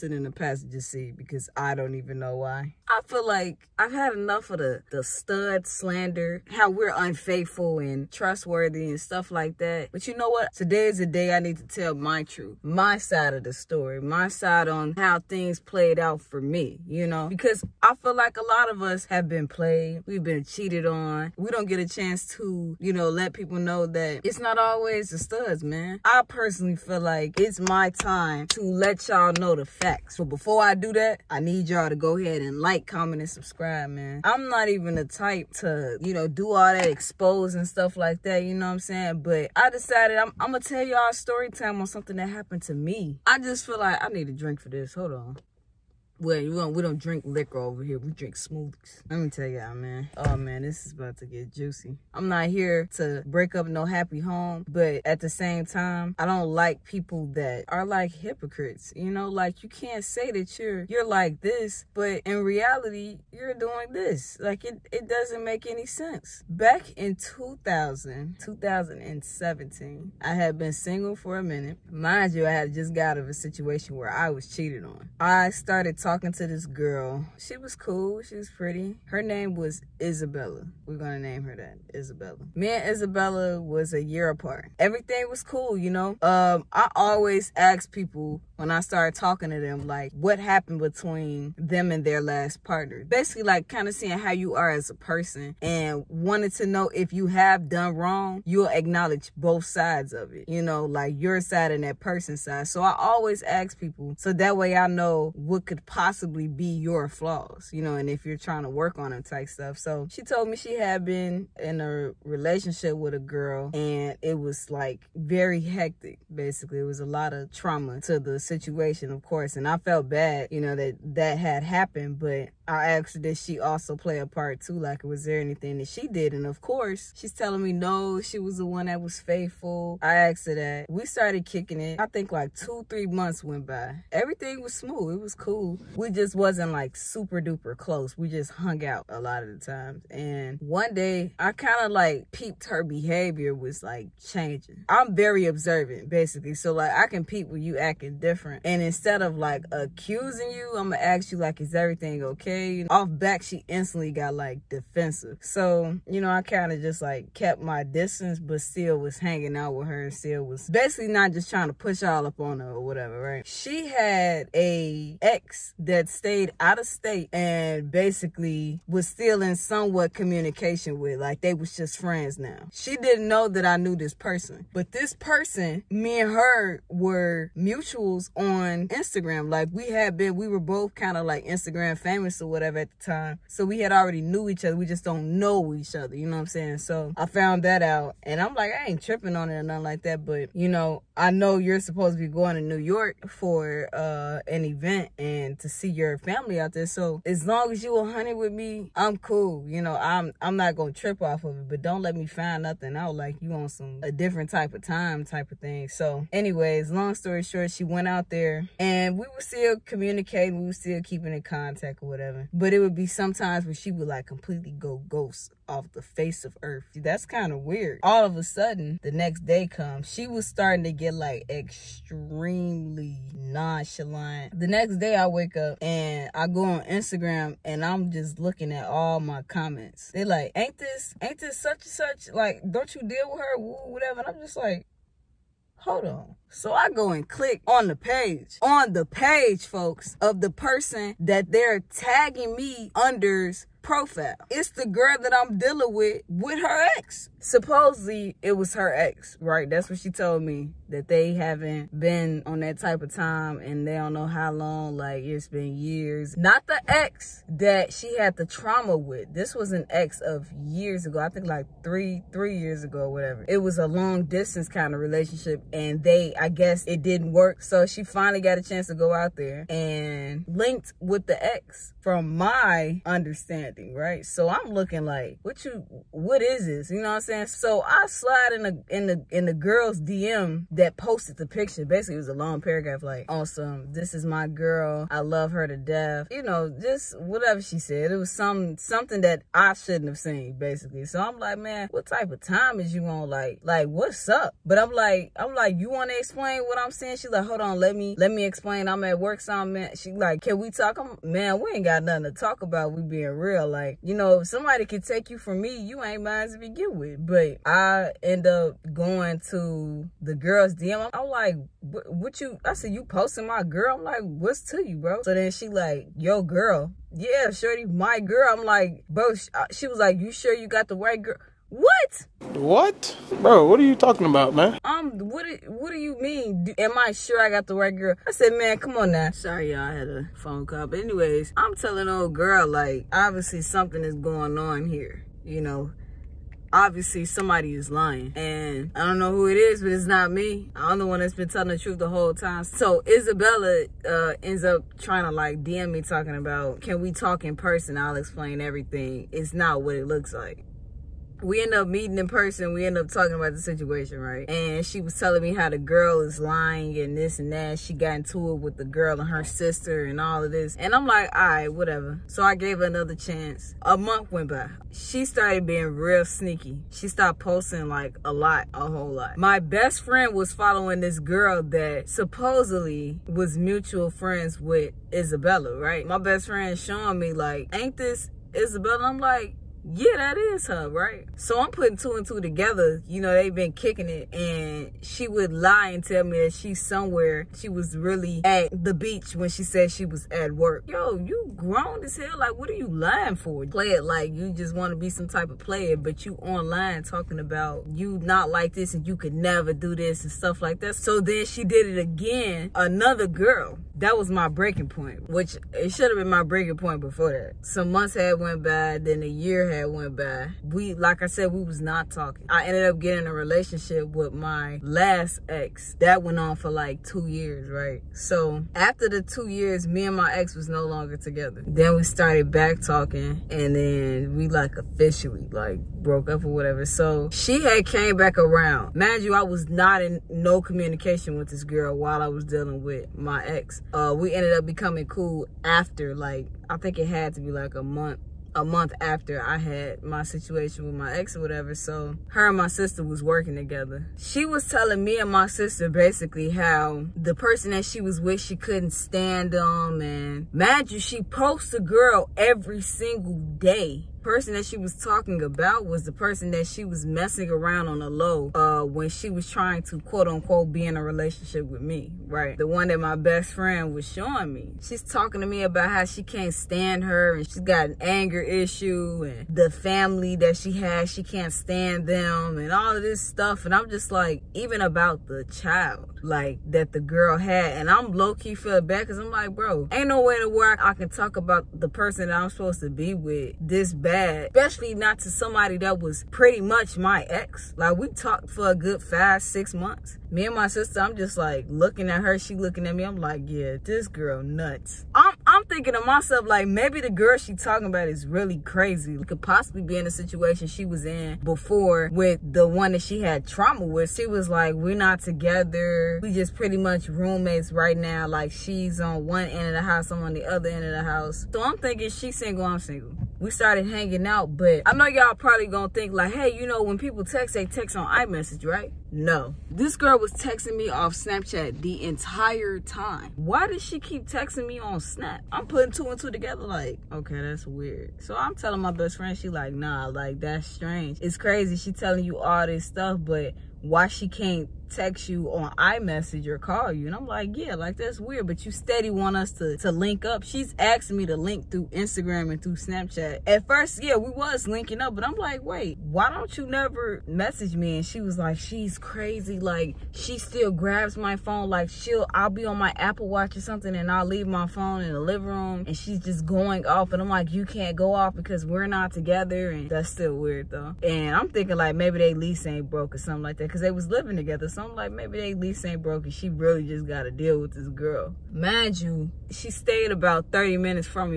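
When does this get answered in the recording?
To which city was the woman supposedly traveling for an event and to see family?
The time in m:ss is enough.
3:12.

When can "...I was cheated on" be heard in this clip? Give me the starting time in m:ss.
1:14.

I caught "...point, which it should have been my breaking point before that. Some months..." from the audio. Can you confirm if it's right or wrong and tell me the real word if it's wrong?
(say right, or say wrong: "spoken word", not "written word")
right.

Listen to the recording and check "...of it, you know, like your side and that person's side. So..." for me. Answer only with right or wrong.
right.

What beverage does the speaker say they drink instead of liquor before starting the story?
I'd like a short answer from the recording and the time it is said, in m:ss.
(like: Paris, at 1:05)
Smoothies, at 0:48.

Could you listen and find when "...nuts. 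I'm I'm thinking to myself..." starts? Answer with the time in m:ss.
8:14.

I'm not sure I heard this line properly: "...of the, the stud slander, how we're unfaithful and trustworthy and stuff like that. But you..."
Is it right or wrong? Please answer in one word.
right.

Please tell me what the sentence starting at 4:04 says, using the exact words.
It's the girl that I'm dealing with, with her ex.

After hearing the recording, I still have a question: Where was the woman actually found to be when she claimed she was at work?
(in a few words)
The beach.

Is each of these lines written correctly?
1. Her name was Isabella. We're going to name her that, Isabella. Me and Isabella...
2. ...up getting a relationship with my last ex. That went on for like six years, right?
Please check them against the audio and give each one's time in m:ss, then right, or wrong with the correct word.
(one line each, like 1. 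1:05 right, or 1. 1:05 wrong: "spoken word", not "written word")
1. 1:19 right
2. 6:52 wrong: "two", not "six".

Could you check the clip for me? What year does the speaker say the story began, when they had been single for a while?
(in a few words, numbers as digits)
2017.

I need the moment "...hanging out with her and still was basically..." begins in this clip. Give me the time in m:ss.
2:39.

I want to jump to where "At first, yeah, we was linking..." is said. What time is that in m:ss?
9:03.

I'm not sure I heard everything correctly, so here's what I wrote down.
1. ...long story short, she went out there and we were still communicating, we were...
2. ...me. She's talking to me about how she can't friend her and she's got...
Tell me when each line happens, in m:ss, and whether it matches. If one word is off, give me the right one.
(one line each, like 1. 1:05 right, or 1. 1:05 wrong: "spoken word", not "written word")
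1. 3:26 right
2. 7:44 wrong: "stand", not "friend".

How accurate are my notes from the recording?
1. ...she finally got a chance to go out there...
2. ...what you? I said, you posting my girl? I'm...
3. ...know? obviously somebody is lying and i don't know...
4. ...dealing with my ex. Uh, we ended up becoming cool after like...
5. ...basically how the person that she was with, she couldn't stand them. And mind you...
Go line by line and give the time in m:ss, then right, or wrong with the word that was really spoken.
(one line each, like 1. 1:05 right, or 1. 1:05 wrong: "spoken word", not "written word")
1. 4:27 right
2. 5:11 right
3. 5:35 right
4. 7:12 right
5. 7:25 right.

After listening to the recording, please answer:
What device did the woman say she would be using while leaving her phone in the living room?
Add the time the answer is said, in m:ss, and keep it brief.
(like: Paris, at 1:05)
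Apple Watch, at 9:12.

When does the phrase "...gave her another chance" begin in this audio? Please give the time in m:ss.
6:02.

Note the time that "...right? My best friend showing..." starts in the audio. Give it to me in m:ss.
6:15.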